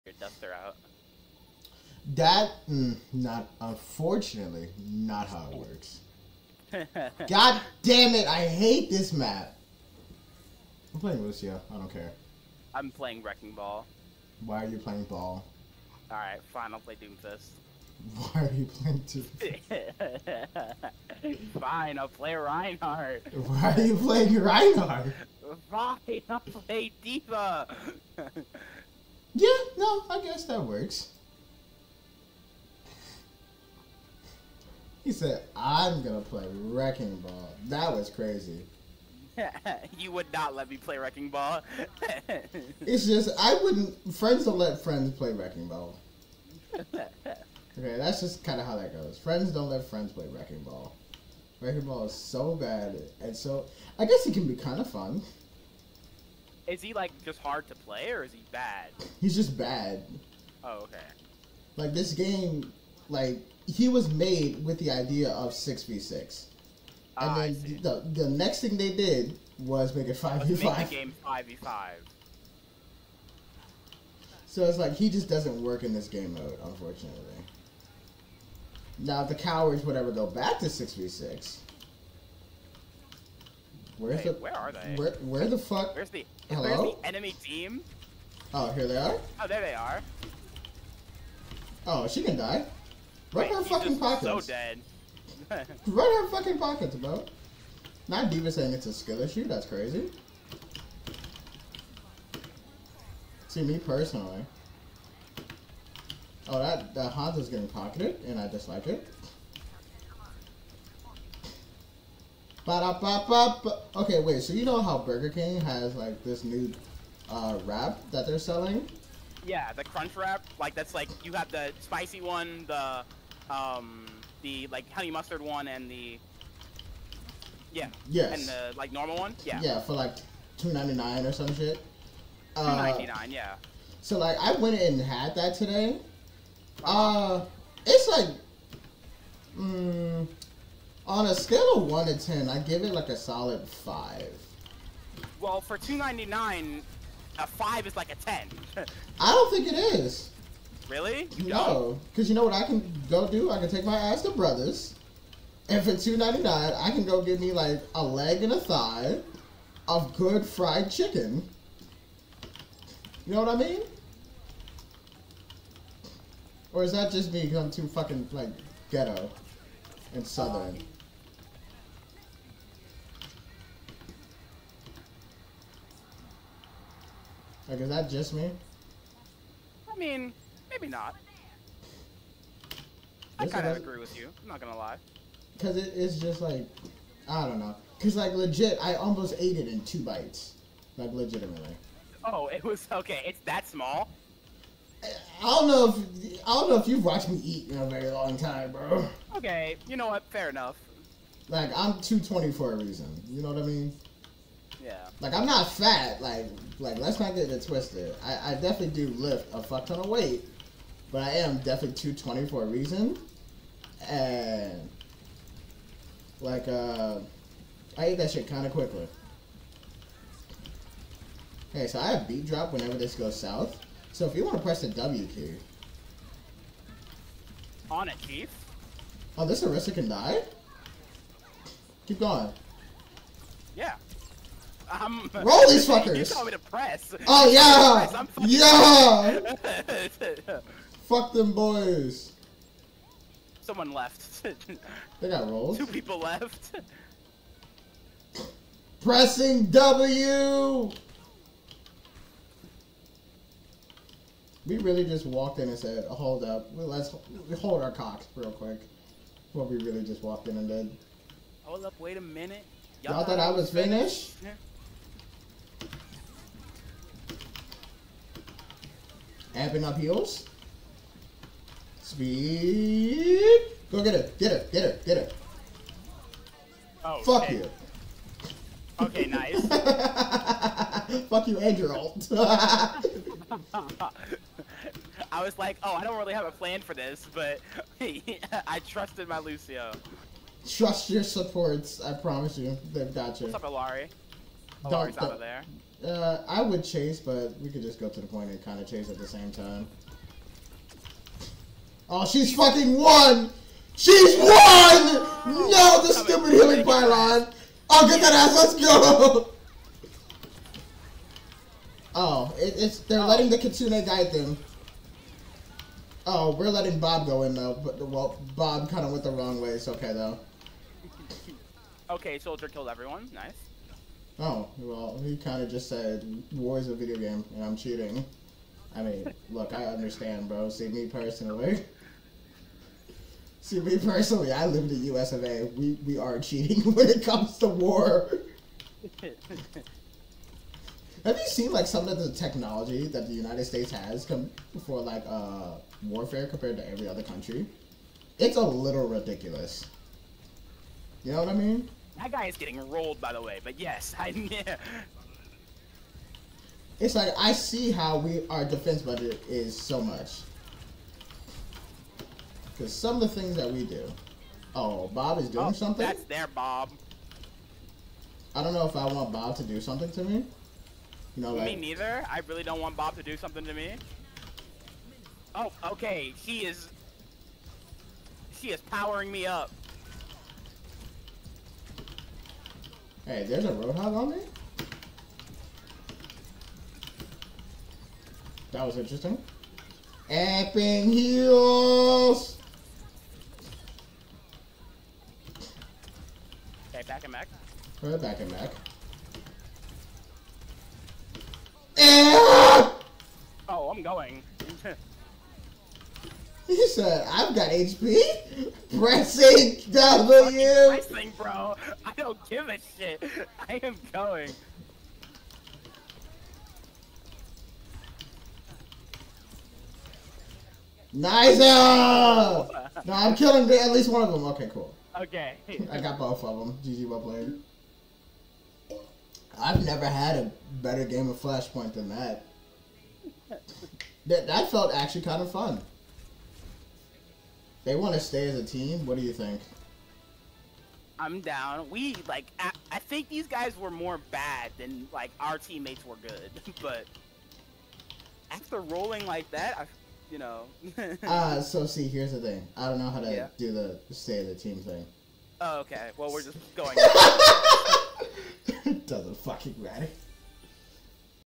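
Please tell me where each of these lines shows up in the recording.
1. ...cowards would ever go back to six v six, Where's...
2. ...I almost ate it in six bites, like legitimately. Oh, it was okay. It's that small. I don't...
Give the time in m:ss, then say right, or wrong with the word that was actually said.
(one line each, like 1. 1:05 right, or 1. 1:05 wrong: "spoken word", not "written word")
1. 1:19 right
2. 3:08 wrong: "two", not "six".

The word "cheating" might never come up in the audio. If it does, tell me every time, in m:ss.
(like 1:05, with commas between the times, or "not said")
5:27, 5:36.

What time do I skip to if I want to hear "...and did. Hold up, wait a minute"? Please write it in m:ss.
4:20.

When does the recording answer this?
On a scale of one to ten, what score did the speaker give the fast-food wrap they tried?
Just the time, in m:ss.
2:23.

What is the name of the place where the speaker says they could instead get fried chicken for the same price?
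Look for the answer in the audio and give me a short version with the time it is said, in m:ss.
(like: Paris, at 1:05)
Brothers, at 2:34.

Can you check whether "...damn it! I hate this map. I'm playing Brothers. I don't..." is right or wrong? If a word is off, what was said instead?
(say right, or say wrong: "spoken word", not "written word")
wrong: "Lucio", not "Brothers".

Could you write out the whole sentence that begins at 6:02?
Because some of the things that we do.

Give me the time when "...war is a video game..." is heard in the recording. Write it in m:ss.
5:26.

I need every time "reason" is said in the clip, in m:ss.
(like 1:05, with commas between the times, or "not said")
3:22, 3:32.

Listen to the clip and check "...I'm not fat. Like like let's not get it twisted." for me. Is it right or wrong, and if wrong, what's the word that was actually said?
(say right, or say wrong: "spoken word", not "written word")
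right.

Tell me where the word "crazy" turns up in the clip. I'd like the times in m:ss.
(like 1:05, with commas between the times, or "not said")
0:38, 1:39.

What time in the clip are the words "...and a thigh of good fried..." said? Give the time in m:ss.
2:38.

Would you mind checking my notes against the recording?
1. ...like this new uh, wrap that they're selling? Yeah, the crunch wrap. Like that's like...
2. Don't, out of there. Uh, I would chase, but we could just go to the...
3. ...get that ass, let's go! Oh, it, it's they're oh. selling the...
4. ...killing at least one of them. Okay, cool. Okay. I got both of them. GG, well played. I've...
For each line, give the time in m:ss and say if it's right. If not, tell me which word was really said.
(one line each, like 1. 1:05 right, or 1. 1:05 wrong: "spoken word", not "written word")
1. 1:55 right
2. 4:54 right
3. 5:08 wrong: "letting", not "selling"
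4. 7:03 right.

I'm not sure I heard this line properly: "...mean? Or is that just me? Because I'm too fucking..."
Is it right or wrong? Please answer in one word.
right.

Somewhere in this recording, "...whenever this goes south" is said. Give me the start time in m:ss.
3:42.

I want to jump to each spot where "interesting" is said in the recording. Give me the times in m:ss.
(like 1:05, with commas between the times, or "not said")
6:28.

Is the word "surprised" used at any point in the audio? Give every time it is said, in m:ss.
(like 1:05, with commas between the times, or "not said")
not said.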